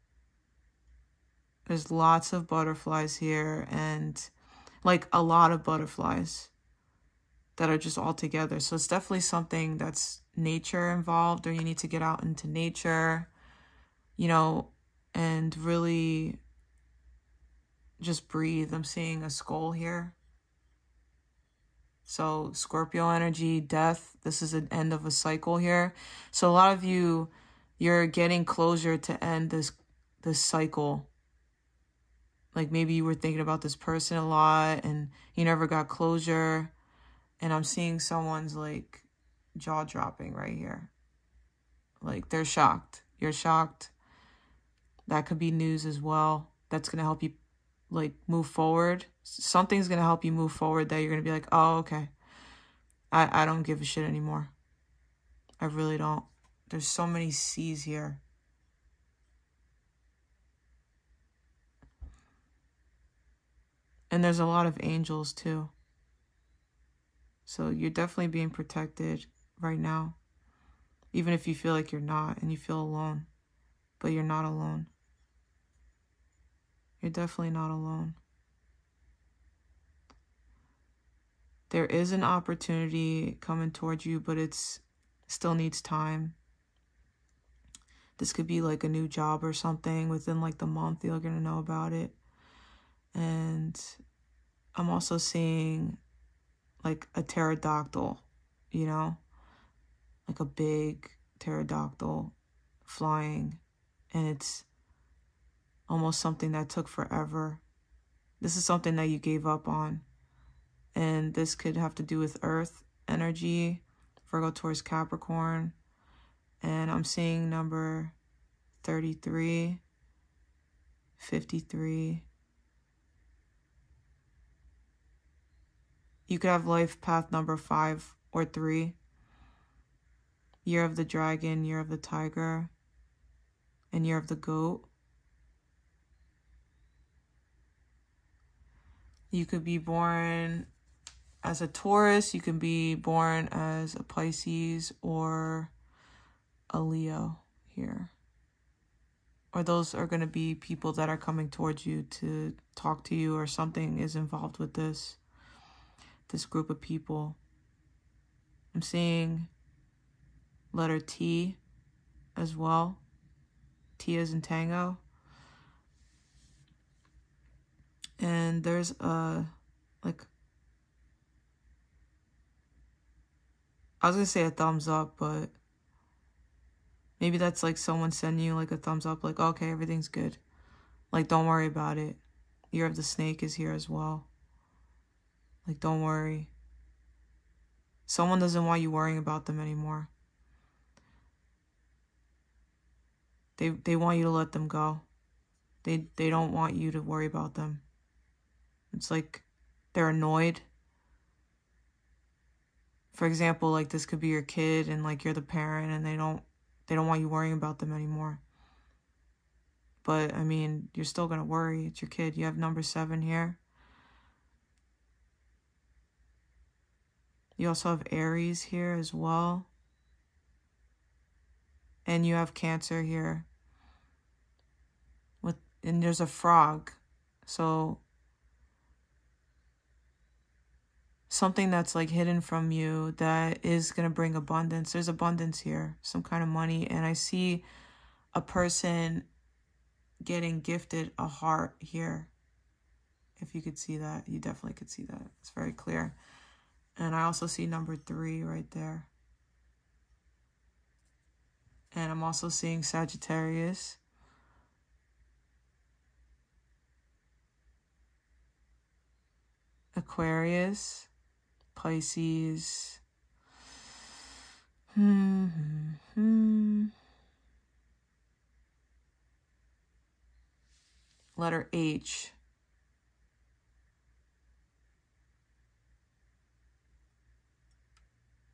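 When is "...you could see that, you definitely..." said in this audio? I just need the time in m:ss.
4:03.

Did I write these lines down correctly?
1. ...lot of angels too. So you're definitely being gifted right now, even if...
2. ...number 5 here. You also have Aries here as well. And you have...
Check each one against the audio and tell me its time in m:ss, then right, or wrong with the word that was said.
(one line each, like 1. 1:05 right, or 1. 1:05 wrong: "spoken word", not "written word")
1. 1:04 wrong: "protected", not "gifted"
2. 3:32 wrong: "7", not "5".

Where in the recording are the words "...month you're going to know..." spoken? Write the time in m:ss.
1:30.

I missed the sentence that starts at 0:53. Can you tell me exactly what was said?
I, I don't give a shit anymore.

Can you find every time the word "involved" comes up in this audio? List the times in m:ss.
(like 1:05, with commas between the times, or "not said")
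0:10, 2:34.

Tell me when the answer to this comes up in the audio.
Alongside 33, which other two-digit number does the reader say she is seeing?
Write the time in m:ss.
2:01.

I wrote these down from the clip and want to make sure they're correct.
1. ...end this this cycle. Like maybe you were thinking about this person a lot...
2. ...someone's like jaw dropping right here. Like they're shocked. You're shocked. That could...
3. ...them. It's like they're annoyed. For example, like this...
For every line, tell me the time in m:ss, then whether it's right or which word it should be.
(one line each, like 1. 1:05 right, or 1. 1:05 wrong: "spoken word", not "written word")
1. 0:29 right
2. 0:37 right
3. 3:17 right.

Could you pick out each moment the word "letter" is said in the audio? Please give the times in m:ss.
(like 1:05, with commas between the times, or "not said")
2:40, 4:31.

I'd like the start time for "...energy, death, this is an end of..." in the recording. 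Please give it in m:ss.
0:23.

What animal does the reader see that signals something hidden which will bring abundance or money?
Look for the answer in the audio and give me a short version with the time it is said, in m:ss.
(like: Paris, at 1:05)
frog, at 3:46.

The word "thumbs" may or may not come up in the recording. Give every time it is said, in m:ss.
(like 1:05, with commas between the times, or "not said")
2:54, 2:58.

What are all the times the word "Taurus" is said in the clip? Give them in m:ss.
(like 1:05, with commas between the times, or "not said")
1:54, 2:21.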